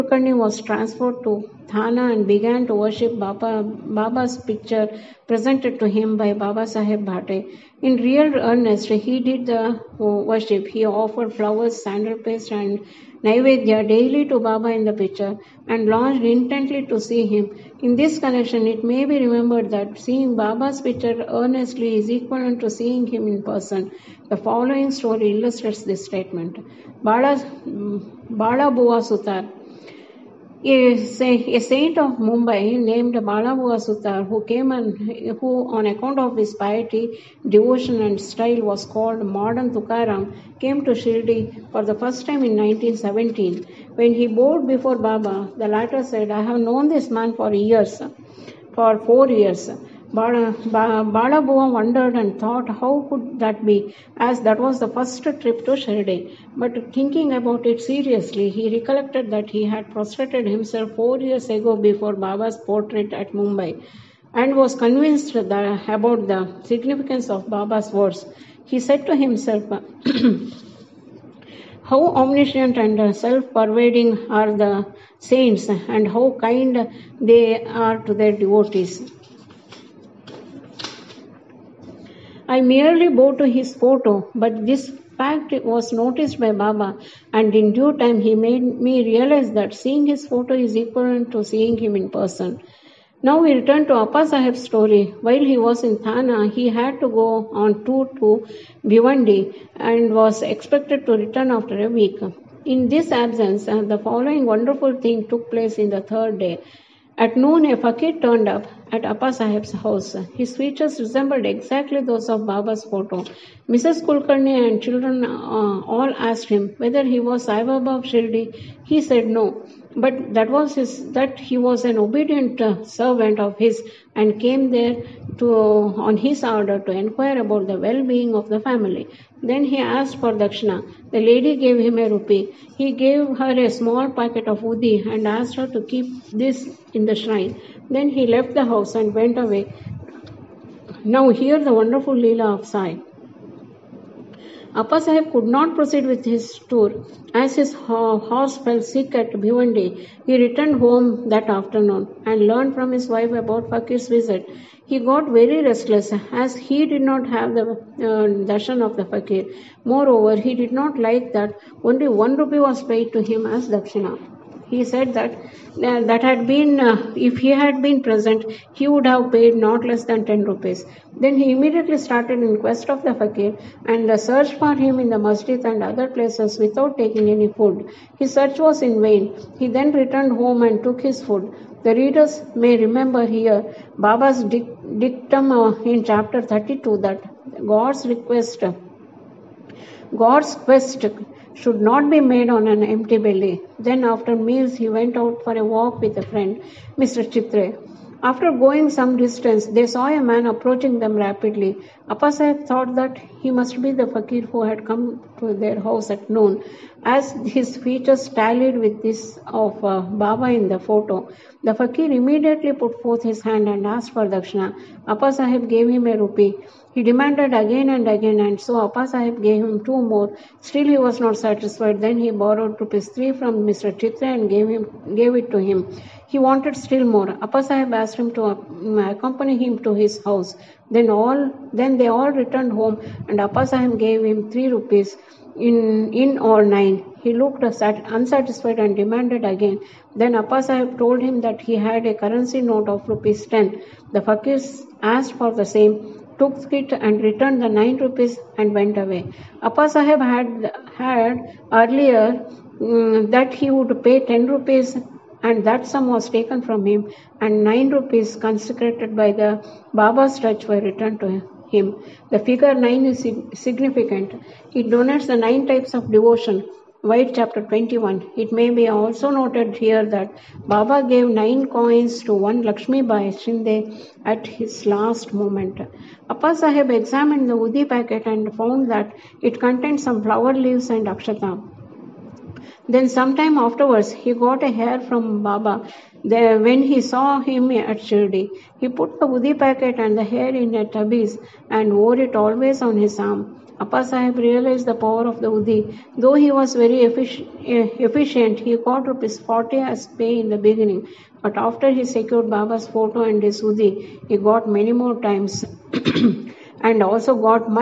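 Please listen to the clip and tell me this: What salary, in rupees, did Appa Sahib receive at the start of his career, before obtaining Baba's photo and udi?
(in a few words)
40 rupees.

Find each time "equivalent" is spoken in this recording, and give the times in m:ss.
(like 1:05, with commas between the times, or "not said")
0:22, 1:30.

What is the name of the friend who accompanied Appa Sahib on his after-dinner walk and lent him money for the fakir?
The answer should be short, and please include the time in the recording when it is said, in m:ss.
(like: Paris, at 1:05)
Mr. Chitre, at 3:16.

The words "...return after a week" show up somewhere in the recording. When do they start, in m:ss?
1:41.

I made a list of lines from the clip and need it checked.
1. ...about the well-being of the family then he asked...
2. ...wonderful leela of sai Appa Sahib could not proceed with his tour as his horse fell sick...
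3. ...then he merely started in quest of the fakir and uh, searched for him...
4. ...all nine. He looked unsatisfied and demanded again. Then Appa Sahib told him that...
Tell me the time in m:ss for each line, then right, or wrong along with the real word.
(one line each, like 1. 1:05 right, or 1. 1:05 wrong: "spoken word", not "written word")
1. 2:07 right
2. 2:21 right
3. 2:51 wrong: "immediately", not "merely"
4. 3:56 right.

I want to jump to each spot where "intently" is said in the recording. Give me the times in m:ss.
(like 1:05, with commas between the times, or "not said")
0:16.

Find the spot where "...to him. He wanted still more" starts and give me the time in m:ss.
3:45.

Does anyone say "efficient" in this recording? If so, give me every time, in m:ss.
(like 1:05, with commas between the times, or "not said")
4:57.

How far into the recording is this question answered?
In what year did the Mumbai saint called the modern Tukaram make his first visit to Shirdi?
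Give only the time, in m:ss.
0:42.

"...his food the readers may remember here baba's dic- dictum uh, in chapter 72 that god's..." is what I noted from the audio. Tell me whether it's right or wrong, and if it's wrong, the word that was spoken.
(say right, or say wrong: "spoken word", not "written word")
wrong: "32", not "72".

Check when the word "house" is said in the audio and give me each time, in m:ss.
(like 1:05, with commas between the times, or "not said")
1:49, 2:18, 3:25, 3:50.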